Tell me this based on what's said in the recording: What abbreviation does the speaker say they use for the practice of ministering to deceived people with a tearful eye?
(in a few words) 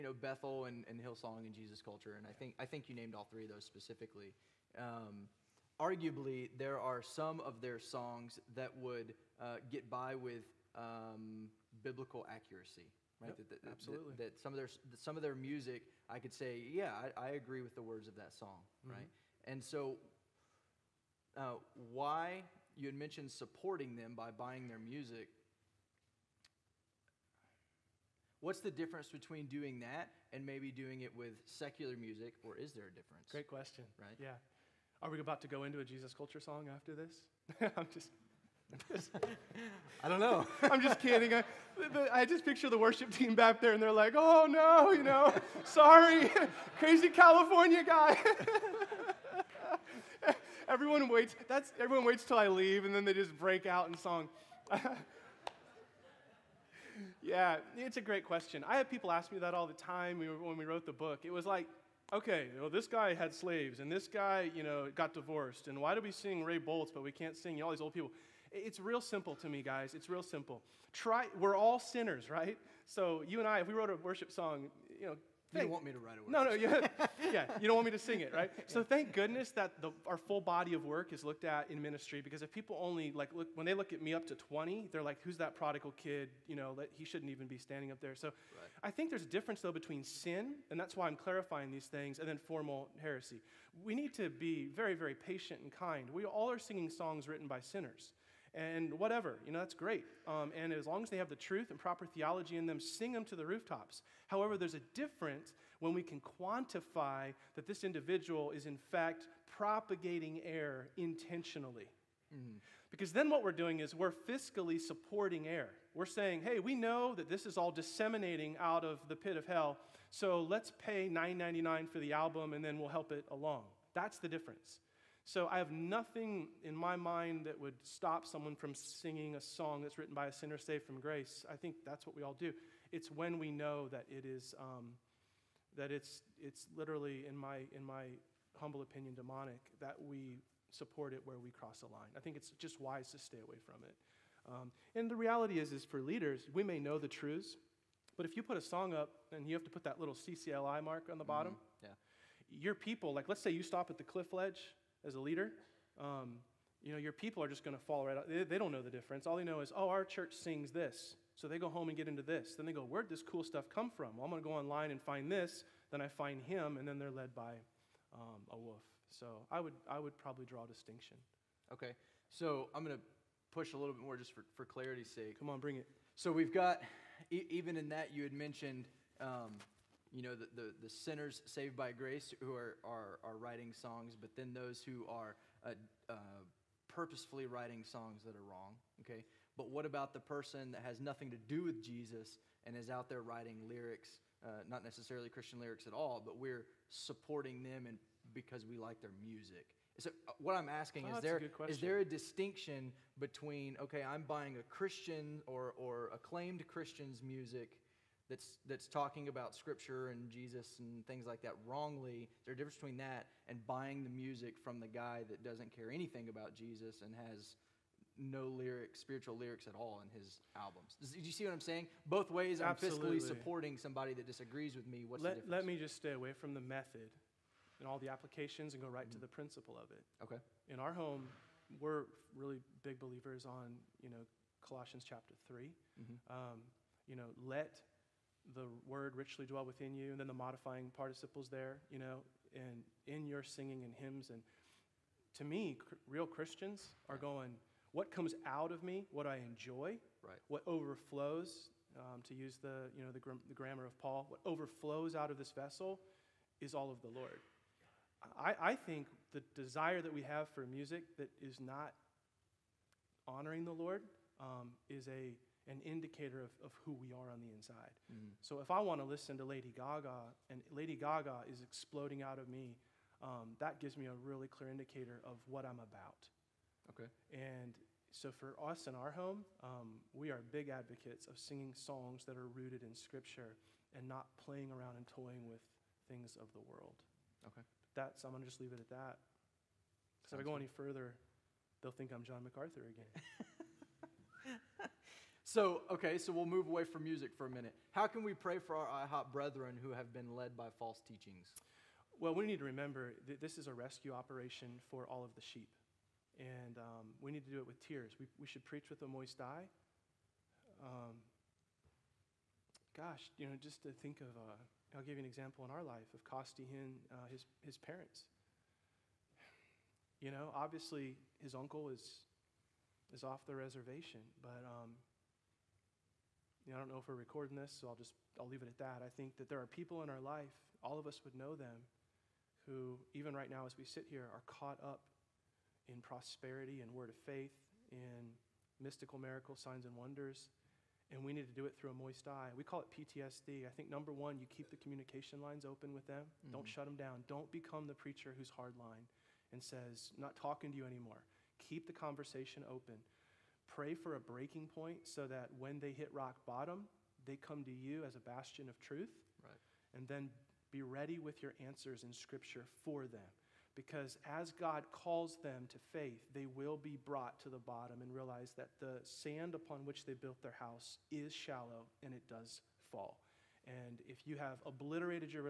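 PTSD.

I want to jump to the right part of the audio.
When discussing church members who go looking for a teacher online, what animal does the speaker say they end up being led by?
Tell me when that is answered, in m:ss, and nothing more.
2:48.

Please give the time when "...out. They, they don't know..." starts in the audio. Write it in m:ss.
2:38.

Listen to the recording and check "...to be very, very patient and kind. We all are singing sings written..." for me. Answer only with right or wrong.
wrong.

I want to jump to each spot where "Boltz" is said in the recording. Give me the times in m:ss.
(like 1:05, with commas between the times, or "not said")
1:06.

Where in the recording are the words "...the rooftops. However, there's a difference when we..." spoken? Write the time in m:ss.
1:43.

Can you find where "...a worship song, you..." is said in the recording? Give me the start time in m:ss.
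1:13.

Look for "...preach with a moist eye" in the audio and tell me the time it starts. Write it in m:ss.
5:08.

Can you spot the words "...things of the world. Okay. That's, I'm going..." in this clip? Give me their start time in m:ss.
4:46.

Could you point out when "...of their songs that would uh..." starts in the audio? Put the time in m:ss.
0:07.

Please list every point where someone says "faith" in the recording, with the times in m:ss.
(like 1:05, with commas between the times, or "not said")
5:37, 6:05.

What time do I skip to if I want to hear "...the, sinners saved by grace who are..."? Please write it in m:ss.
3:00.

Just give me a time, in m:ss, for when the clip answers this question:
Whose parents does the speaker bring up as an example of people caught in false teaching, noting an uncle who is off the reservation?
5:16.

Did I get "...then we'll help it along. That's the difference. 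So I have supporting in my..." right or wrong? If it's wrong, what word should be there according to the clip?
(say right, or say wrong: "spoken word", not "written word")
wrong: "nothing", not "supporting".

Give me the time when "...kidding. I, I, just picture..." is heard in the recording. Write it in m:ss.
0:41.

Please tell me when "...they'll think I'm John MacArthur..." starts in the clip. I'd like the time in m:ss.
4:51.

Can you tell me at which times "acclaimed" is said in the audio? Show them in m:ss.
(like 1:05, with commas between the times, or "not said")
3:26.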